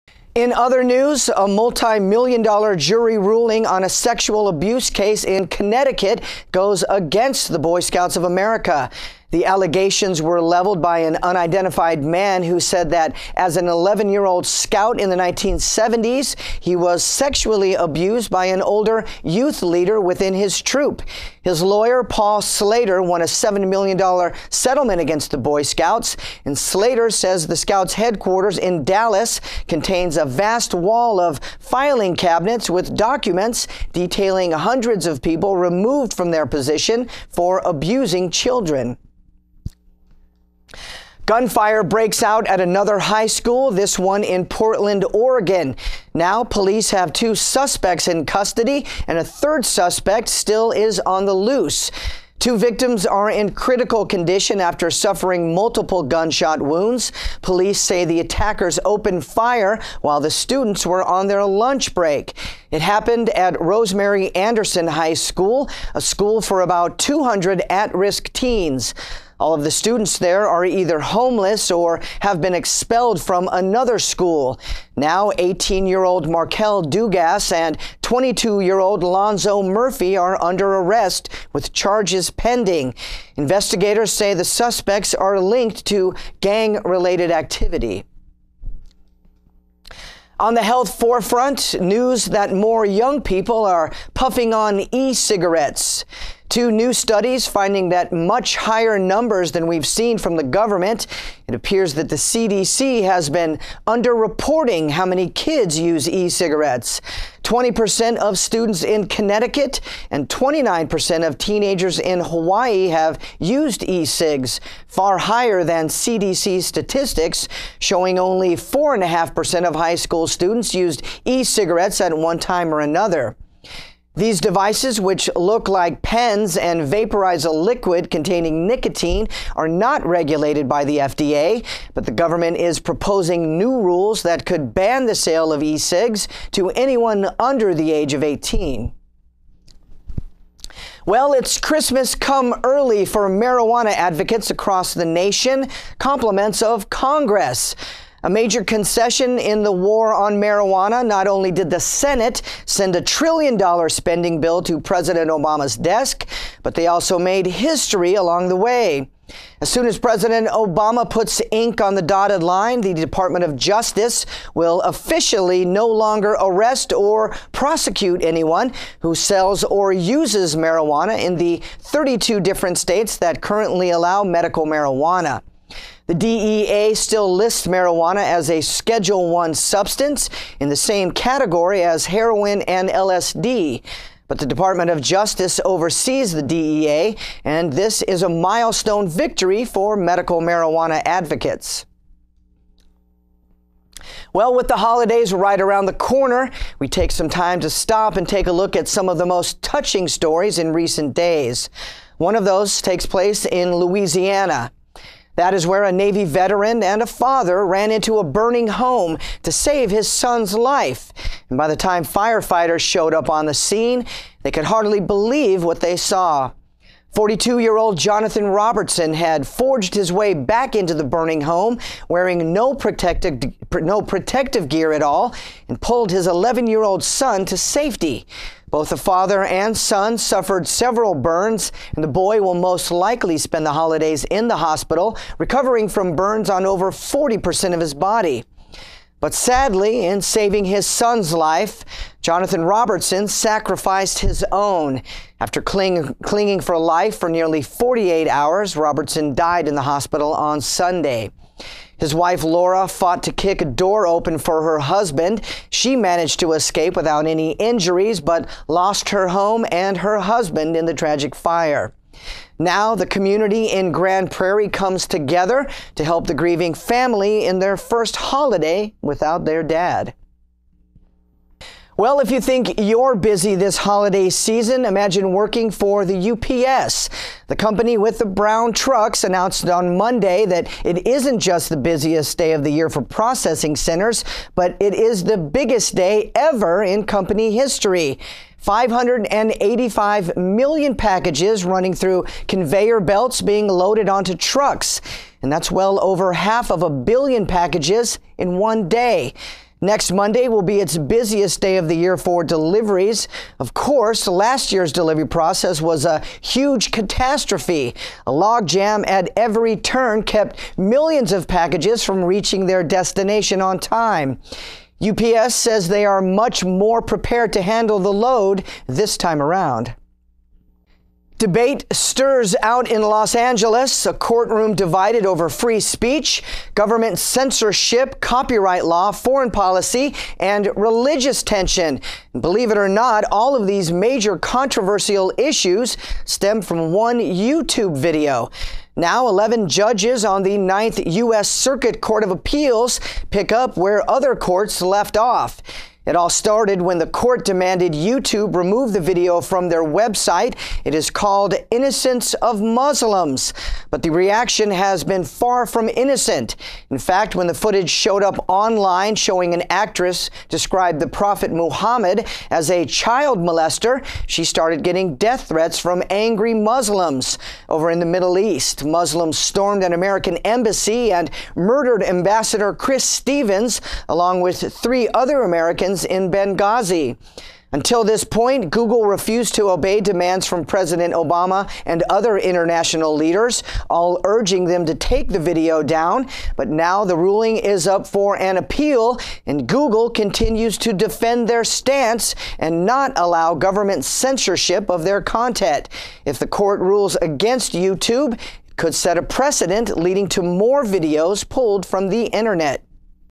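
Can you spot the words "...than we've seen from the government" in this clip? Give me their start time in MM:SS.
01:39.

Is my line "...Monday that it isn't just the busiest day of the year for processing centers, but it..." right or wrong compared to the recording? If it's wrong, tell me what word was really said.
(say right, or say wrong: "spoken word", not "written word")
right.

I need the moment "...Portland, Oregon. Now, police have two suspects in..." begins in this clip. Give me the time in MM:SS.
00:44.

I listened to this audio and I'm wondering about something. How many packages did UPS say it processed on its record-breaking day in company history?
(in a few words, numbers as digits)
585 million.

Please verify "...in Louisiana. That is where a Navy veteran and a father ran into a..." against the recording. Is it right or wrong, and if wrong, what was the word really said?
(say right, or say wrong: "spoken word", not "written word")
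right.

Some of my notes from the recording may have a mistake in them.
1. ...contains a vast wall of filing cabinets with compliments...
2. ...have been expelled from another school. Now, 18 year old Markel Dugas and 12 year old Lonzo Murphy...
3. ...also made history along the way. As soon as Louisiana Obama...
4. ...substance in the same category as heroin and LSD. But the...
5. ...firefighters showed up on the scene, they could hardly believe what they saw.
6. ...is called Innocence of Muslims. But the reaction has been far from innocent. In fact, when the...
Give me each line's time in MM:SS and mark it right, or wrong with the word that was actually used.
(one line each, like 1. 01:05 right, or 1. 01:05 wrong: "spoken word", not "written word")
1. 00:29 wrong: "documents", not "compliments"
2. 01:12 wrong: "22", not "12"
3. 02:36 wrong: "President", not "Louisiana"
4. 02:59 right
5. 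03:32 right
6. 05:50 right.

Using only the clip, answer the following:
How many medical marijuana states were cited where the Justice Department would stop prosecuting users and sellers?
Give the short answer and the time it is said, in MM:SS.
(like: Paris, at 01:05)
32, at 02:51.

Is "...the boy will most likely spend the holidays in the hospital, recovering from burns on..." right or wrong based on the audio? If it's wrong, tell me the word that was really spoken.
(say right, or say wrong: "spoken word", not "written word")
right.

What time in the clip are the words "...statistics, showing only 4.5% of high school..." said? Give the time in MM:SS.
01:56.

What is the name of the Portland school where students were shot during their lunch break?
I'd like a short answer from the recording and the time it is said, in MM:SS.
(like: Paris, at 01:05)
Rosemary Anderson High School, at 01:03.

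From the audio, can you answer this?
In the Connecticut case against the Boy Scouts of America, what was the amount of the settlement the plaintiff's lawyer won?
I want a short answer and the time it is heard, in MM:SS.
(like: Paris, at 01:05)
$7 million, at 00:23.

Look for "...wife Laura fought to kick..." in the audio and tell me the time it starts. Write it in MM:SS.
04:12.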